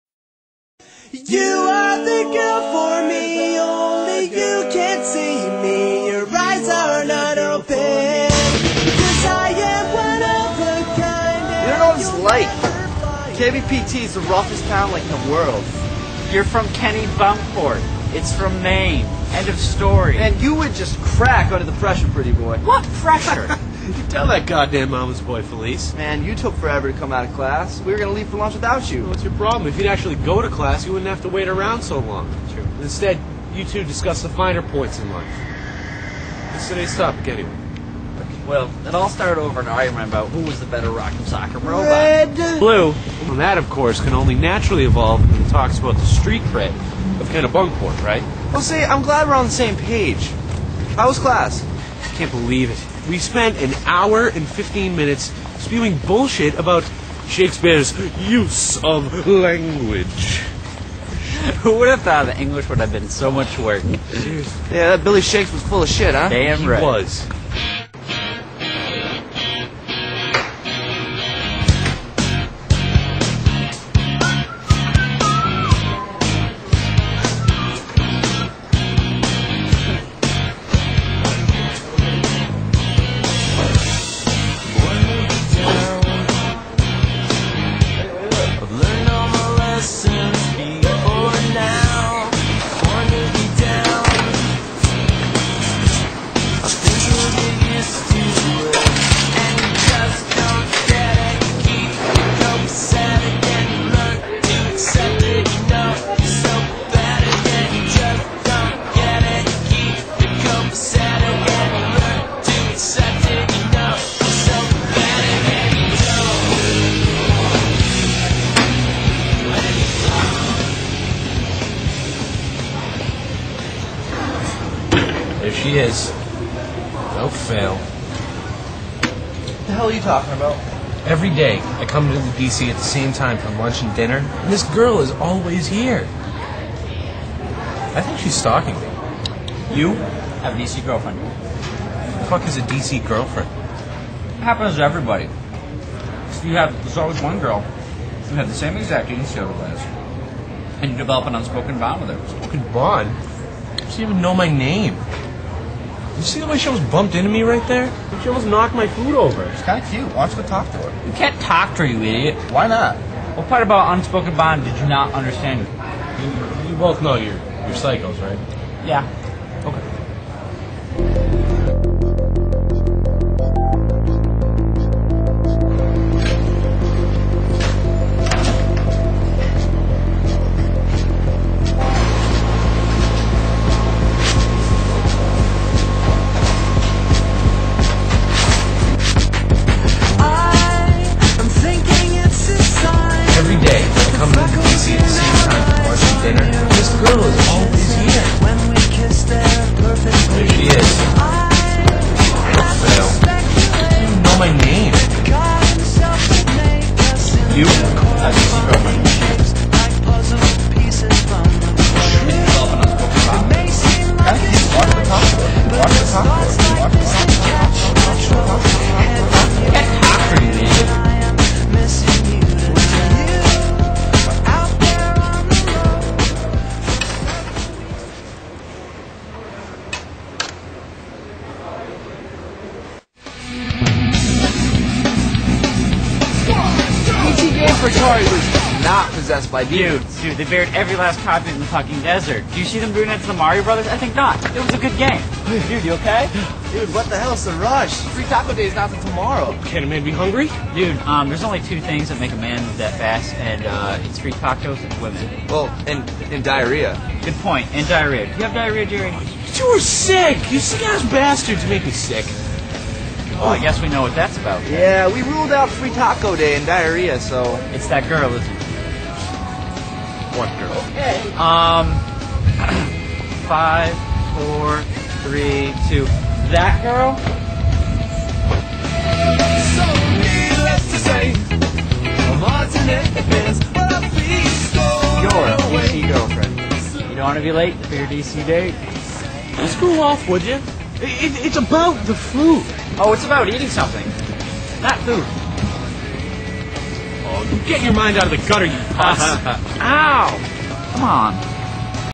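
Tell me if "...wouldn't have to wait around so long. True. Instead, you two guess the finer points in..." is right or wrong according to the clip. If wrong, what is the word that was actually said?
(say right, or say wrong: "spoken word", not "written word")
wrong: "discuss", not "guess".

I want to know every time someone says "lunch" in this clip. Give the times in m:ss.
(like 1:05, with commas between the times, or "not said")
0:28, 2:13.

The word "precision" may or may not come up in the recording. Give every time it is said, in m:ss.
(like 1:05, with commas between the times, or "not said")
not said.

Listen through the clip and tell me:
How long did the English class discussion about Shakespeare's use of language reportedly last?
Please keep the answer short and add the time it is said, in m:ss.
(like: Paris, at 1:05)
1 hour and 15 minutes, at 0:53.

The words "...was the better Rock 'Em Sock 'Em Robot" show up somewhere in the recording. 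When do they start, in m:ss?
0:40.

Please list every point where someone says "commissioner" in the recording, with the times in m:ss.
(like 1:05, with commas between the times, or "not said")
not said.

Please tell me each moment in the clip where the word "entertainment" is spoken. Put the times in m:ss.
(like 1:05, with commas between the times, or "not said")
not said.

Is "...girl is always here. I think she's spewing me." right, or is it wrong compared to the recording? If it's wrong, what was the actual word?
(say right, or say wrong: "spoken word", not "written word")
wrong: "stalking", not "spewing".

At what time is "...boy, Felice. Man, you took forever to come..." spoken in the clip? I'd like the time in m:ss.
0:25.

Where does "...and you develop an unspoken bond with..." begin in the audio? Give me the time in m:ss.
2:30.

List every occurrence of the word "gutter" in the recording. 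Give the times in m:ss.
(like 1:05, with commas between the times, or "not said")
4:58.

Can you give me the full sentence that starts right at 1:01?
Who would have thought that English would have been so much work?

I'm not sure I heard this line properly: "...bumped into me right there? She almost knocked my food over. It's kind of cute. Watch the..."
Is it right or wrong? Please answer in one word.
right.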